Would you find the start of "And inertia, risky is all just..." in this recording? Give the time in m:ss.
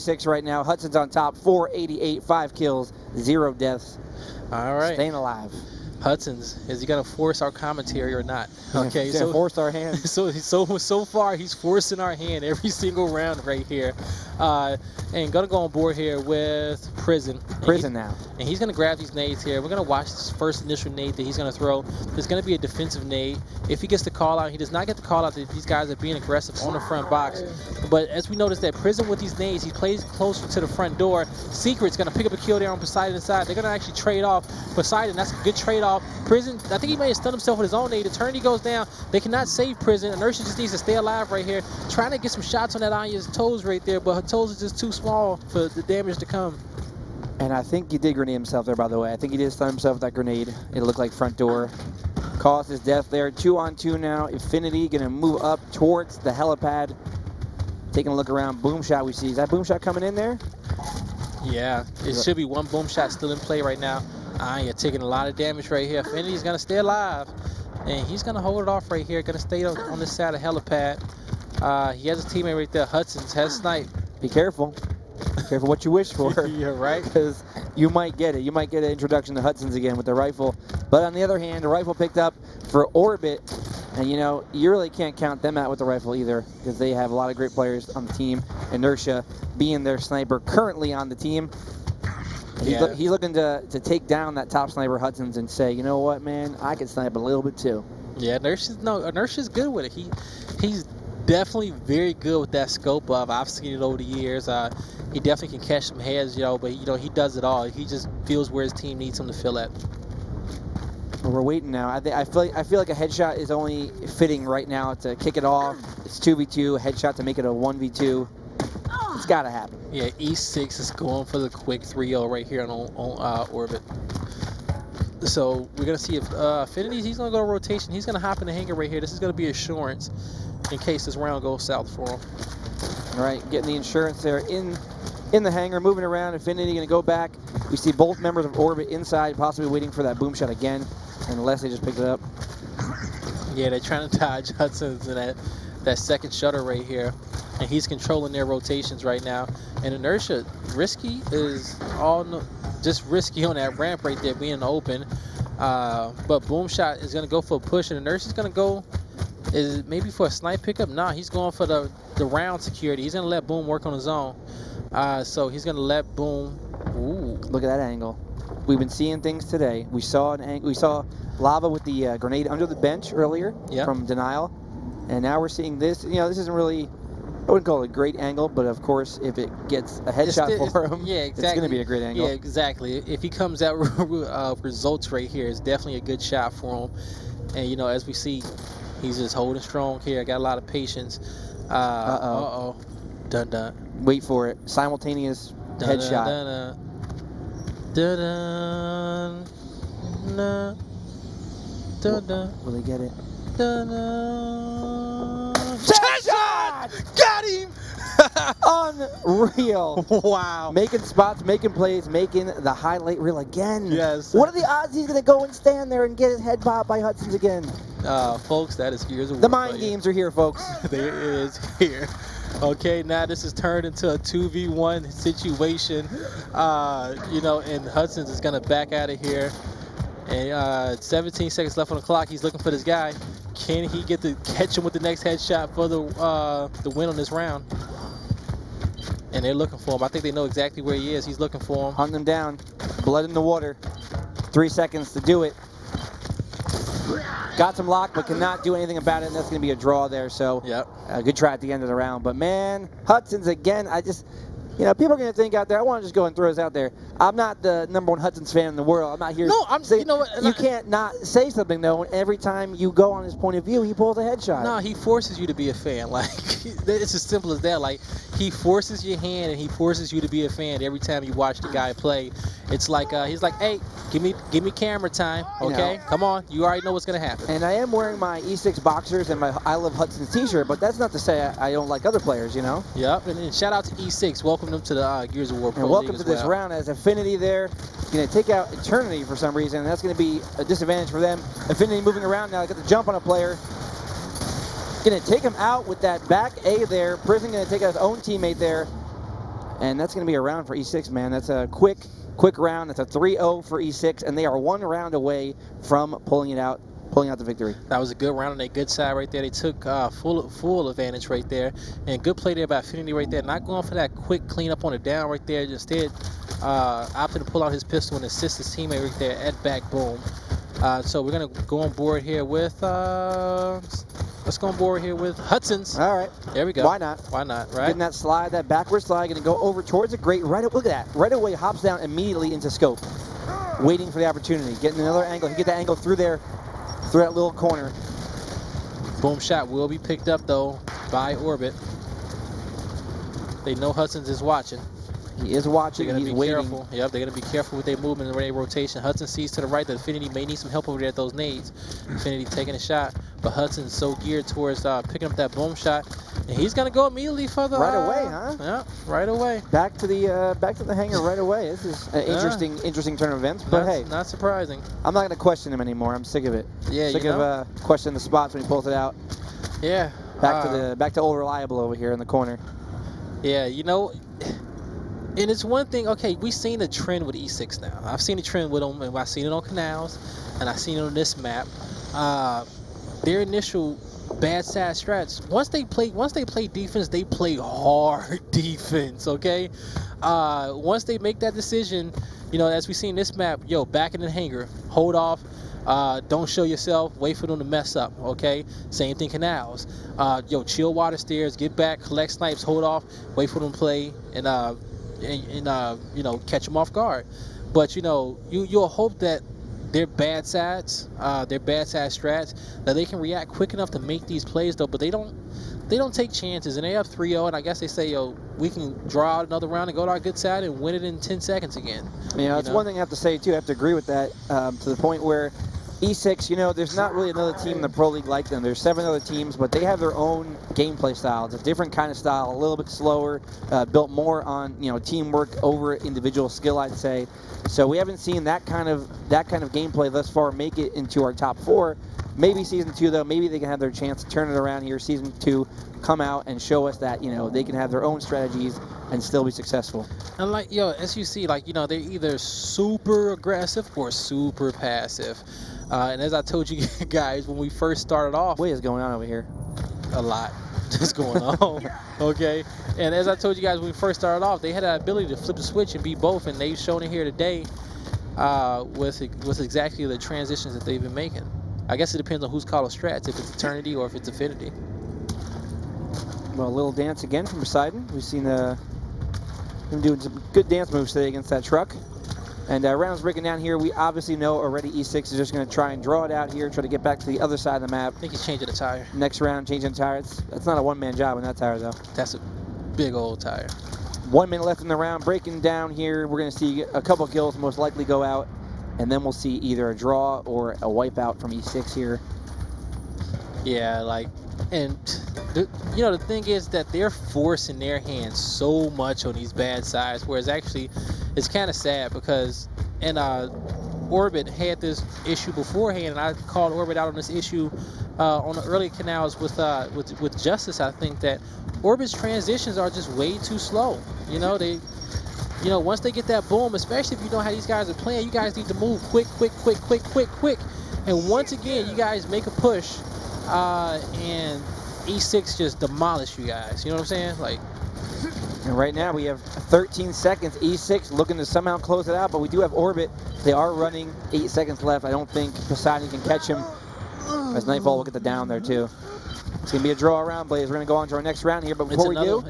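2:29.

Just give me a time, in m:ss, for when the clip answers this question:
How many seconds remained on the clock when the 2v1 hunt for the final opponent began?
3:50.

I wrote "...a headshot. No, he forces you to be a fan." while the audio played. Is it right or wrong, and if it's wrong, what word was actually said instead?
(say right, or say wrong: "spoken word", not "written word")
right.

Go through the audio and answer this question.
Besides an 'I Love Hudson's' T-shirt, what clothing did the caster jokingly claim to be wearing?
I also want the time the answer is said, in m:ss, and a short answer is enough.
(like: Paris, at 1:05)
E6 boxers, at 4:38.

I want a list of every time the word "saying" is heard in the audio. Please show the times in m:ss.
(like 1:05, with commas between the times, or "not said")
4:19, 8:57.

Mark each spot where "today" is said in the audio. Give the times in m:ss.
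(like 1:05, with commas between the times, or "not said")
2:49, 7:47, 8:01.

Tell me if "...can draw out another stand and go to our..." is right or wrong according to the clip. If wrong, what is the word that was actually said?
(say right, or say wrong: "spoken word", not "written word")
wrong: "round", not "stand".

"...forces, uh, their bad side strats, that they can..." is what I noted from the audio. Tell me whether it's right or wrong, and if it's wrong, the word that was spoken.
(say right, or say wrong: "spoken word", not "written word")
wrong: "sides", not "forces".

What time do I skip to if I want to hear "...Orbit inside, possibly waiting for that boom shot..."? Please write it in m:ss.
2:18.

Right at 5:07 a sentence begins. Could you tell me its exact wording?
That was a good round on their good side right there.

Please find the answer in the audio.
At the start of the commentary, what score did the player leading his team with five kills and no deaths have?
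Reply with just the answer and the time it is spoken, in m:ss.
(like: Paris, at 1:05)
488, at 0:01.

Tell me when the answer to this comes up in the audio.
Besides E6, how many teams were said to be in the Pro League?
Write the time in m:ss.
7:08.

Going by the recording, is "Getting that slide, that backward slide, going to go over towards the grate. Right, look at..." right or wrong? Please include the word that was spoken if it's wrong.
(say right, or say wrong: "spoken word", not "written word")
right.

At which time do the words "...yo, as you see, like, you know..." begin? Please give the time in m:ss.
7:30.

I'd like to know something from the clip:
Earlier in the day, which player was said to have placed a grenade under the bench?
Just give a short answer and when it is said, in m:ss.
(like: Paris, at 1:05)
lava, at 2:51.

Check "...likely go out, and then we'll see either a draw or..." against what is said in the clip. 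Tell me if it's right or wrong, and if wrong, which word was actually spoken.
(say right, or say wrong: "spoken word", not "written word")
right.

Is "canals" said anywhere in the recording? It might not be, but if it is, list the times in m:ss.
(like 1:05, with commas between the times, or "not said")
6:19, 6:39, 8:38.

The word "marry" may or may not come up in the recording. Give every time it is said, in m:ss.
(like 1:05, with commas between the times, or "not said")
not said.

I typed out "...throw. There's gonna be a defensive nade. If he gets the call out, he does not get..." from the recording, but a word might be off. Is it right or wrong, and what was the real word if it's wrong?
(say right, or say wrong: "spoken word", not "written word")
right.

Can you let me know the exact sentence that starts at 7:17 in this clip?
So we haven't seen that kind of that kind of gameplay thus far make it into our top four.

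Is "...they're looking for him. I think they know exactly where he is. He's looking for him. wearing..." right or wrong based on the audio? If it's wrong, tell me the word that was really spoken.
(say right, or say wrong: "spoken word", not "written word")
wrong: "hunting", not "wearing".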